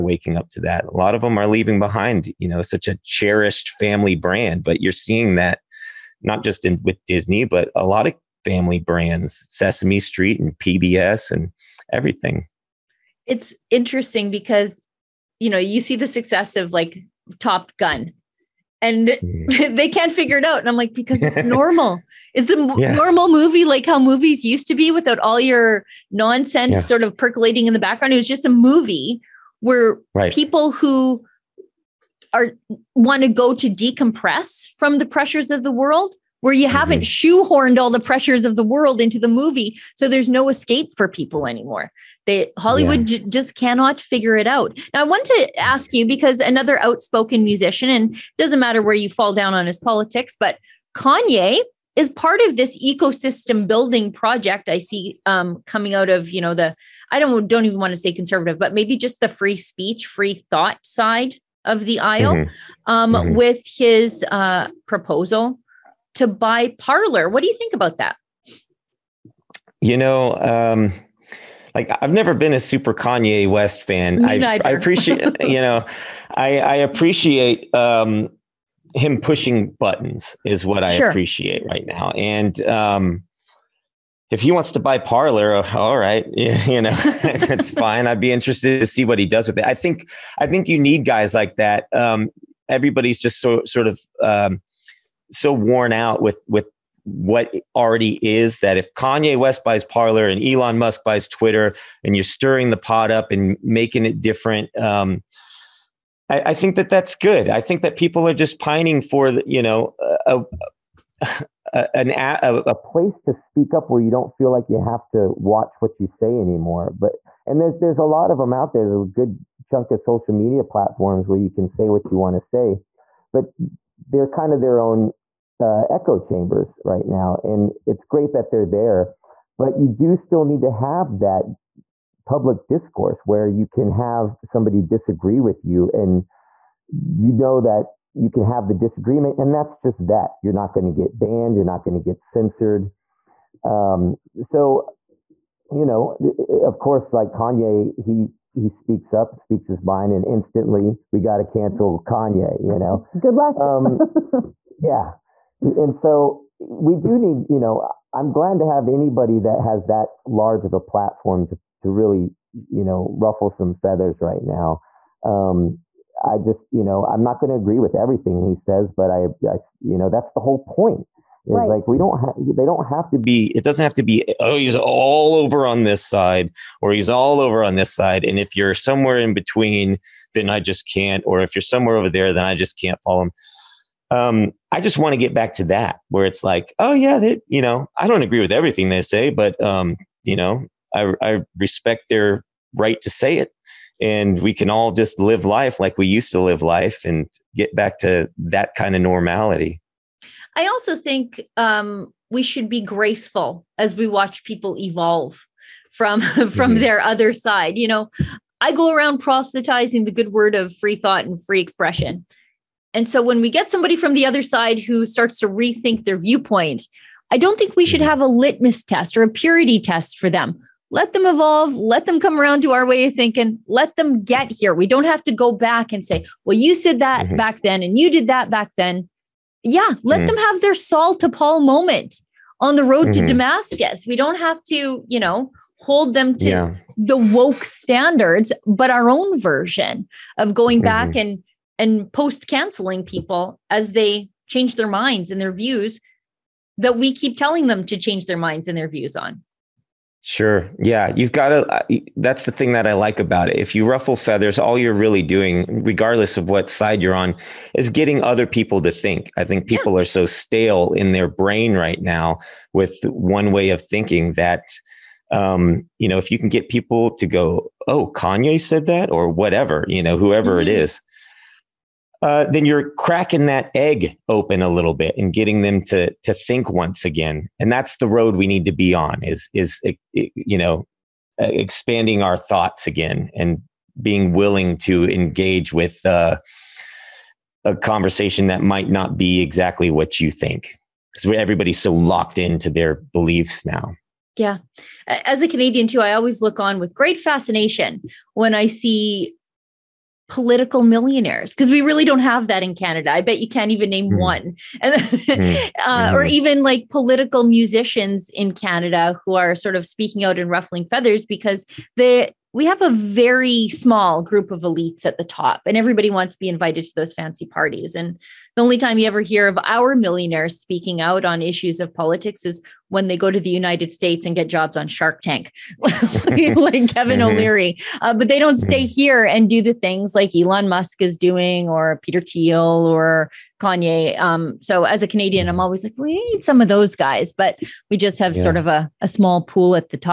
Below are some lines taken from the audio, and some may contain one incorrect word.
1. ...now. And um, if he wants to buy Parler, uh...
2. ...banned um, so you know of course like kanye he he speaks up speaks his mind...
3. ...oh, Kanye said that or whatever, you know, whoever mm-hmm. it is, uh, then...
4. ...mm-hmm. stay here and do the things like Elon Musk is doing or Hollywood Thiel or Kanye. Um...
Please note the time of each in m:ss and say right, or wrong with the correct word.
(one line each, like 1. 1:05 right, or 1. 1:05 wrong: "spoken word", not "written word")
1. 1:21 right
2. 2:22 wrong: "censored", not "banned"
3. 4:27 right
4. 5:28 wrong: "Peter", not "Hollywood".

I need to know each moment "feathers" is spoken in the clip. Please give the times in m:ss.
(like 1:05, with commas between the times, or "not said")
2:43, 4:14, 5:10.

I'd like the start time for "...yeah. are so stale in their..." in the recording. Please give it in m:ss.
4:19.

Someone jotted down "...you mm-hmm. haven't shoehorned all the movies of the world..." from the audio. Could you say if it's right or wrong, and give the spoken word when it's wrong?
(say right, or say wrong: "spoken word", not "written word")
wrong: "pressures", not "movies".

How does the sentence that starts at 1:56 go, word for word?
But, and there's, there's a lot of them out there.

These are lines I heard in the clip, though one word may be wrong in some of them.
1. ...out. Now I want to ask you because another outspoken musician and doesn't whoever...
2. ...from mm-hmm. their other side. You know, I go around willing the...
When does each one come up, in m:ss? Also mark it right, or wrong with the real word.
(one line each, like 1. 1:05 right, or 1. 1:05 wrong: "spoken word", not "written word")
1. 0:44 wrong: "matter", not "whoever"
2. 3:26 wrong: "proselytizing", not "willing".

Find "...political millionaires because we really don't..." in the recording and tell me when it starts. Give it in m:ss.
5:00.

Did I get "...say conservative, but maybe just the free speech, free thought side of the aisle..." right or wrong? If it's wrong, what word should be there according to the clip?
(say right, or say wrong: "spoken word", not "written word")
right.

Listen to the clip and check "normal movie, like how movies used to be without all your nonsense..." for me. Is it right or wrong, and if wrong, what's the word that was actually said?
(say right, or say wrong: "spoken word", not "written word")
right.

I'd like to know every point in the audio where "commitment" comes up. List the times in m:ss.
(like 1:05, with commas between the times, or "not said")
not said.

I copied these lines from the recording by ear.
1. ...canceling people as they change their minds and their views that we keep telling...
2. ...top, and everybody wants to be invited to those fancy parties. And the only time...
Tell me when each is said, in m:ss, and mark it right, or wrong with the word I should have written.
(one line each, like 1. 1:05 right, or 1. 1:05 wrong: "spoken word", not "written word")
1. 4:02 right
2. 5:15 right.